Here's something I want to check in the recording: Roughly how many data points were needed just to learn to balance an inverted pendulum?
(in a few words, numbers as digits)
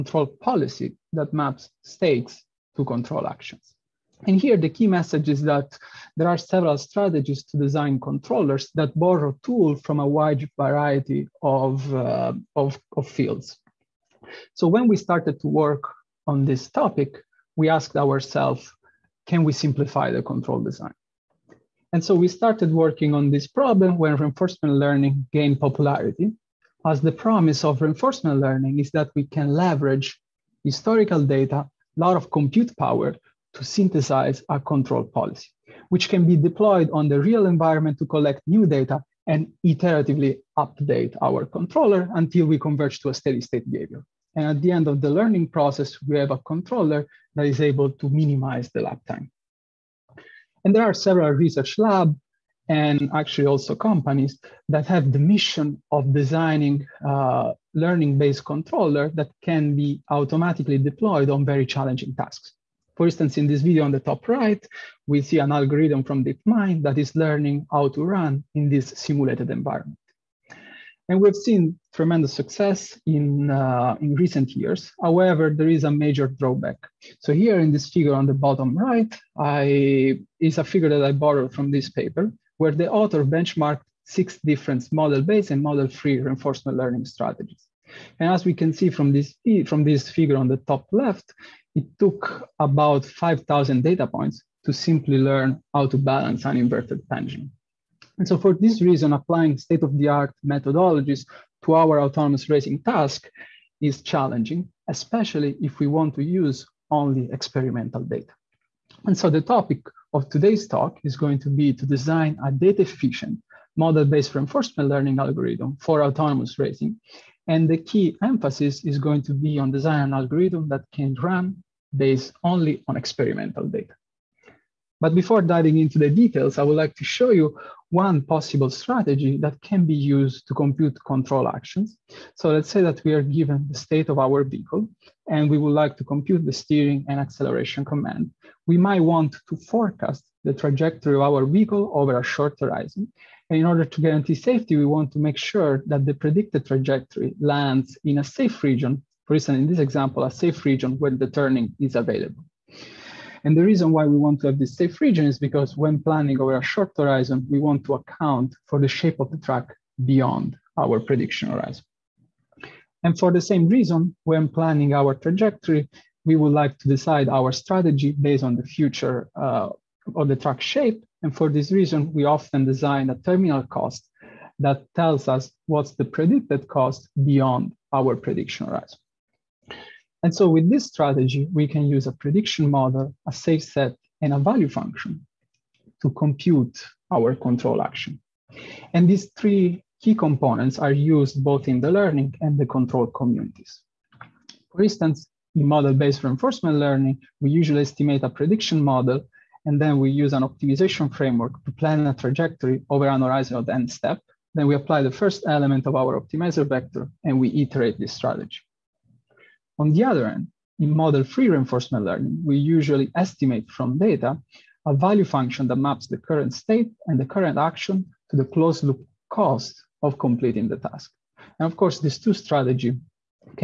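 5,000.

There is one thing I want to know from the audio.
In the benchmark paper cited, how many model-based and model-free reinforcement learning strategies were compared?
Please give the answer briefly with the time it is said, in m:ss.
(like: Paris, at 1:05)
6, at 1:24.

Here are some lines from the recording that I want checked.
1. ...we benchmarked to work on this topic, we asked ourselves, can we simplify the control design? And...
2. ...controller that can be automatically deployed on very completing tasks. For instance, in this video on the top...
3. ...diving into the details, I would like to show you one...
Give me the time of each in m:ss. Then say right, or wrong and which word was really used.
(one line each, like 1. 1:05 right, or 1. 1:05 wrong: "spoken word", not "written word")
1. 0:14 wrong: "started", not "benchmarked"
2. 0:58 wrong: "challenging", not "completing"
3. 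2:05 right.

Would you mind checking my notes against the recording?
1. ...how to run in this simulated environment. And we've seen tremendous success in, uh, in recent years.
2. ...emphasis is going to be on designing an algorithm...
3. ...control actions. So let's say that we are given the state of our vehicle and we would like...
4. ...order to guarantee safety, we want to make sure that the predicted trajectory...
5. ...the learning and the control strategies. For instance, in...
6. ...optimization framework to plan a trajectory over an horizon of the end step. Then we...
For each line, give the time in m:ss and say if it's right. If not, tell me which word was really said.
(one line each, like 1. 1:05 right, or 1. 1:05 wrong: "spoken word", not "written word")
1. 1:07 right
2. 1:58 right
3. 2:11 right
4. 2:23 right
5. 3:11 wrong: "communities", not "strategies"
6. 3:20 right.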